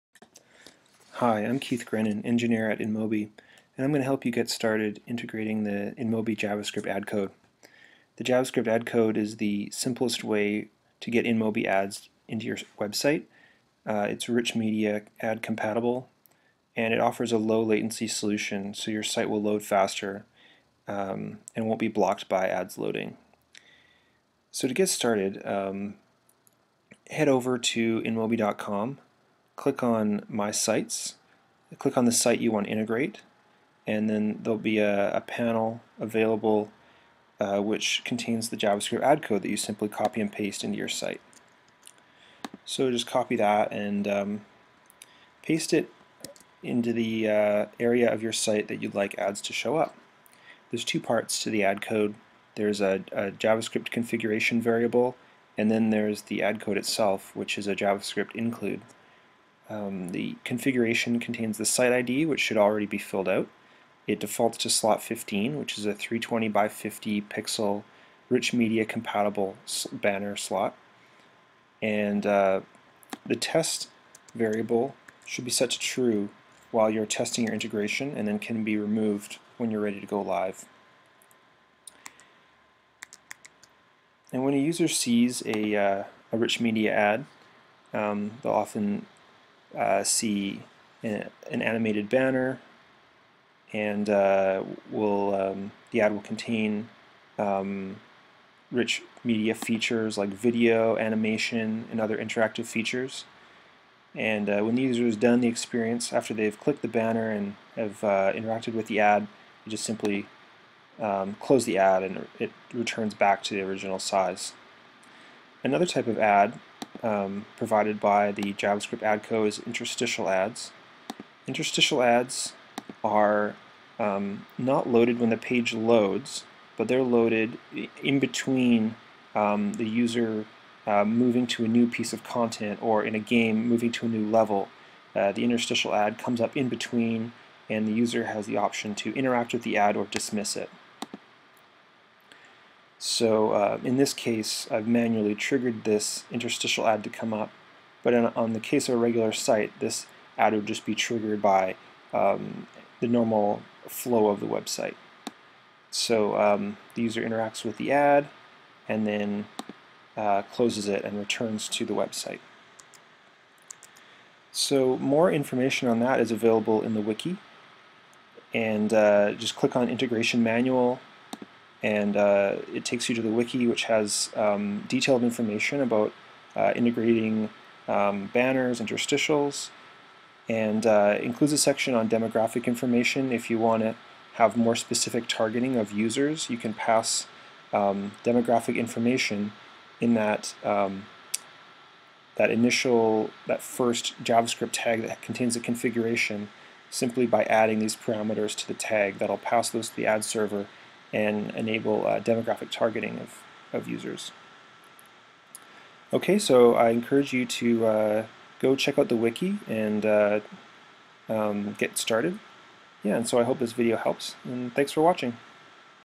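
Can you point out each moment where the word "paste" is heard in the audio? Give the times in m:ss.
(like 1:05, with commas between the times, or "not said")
0:40, 0:45.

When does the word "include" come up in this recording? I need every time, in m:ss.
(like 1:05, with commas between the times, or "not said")
0:58, 3:01.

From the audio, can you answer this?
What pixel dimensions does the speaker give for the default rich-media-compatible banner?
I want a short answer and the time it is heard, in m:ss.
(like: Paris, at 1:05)
320 by 50, at 1:05.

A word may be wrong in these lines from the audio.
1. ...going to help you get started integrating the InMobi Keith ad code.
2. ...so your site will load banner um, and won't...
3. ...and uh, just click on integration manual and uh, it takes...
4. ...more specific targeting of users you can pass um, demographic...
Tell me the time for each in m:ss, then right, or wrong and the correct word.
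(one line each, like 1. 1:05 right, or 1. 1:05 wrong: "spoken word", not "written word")
1. 0:03 wrong: "JavaScript", not "Keith"
2. 0:18 wrong: "faster", not "banner"
3. 2:48 right
4. 3:04 right.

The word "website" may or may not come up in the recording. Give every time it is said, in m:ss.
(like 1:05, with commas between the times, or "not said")
0:12, 2:34, 2:41.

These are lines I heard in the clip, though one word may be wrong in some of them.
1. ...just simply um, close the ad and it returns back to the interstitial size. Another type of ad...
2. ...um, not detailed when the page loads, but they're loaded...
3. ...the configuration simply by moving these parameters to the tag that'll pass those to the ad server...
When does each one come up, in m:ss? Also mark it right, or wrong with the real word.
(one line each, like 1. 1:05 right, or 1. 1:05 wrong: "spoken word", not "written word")
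1. 1:49 wrong: "original", not "interstitial"
2. 2:03 wrong: "loaded", not "detailed"
3. 3:15 wrong: "adding", not "moving".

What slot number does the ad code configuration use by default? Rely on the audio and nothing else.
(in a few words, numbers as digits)
15.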